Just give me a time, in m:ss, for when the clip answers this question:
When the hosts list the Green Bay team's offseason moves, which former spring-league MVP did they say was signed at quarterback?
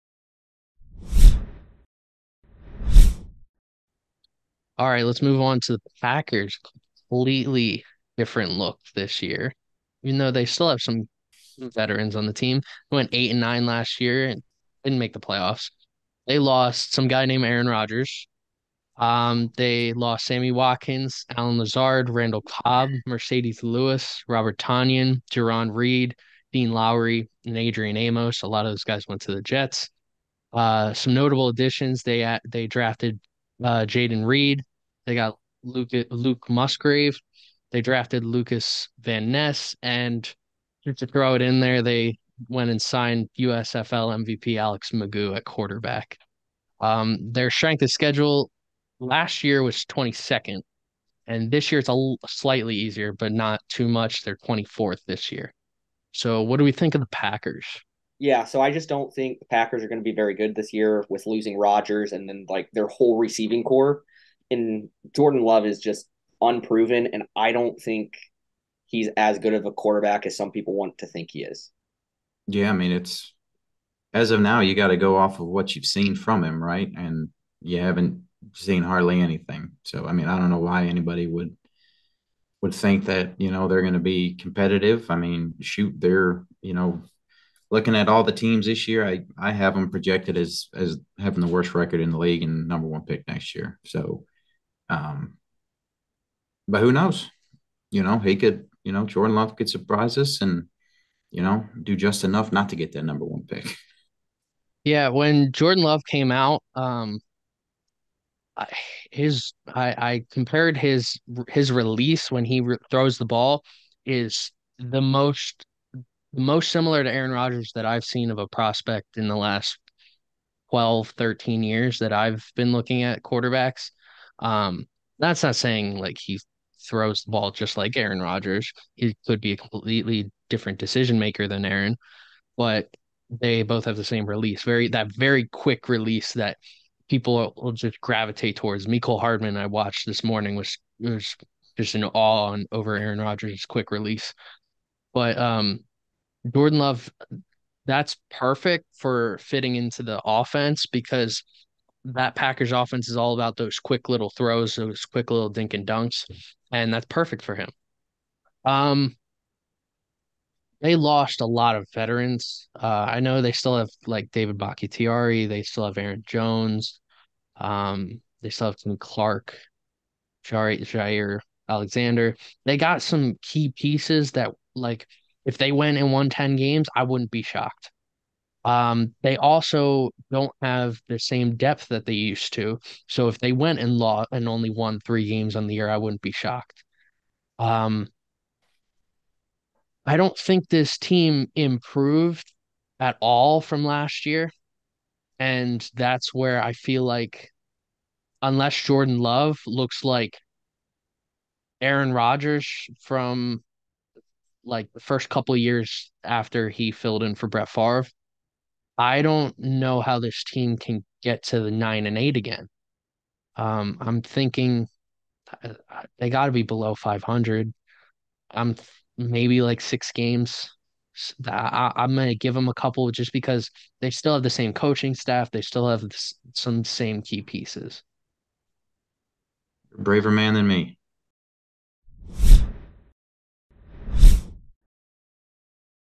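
0:44.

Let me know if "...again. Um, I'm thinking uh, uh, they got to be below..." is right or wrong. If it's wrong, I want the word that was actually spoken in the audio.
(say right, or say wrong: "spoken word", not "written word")
right.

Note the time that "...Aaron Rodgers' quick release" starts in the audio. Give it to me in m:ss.
2:22.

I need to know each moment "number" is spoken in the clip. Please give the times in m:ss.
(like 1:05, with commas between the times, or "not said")
1:32, 1:43.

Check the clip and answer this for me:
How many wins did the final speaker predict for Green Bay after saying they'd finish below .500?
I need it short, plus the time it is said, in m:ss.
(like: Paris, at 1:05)
6, at 3:39.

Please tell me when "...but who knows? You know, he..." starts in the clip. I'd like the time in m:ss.
1:36.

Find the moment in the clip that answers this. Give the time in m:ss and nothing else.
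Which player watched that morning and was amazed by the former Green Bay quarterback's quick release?
2:18.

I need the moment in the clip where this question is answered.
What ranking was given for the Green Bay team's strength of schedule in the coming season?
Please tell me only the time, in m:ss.
0:54.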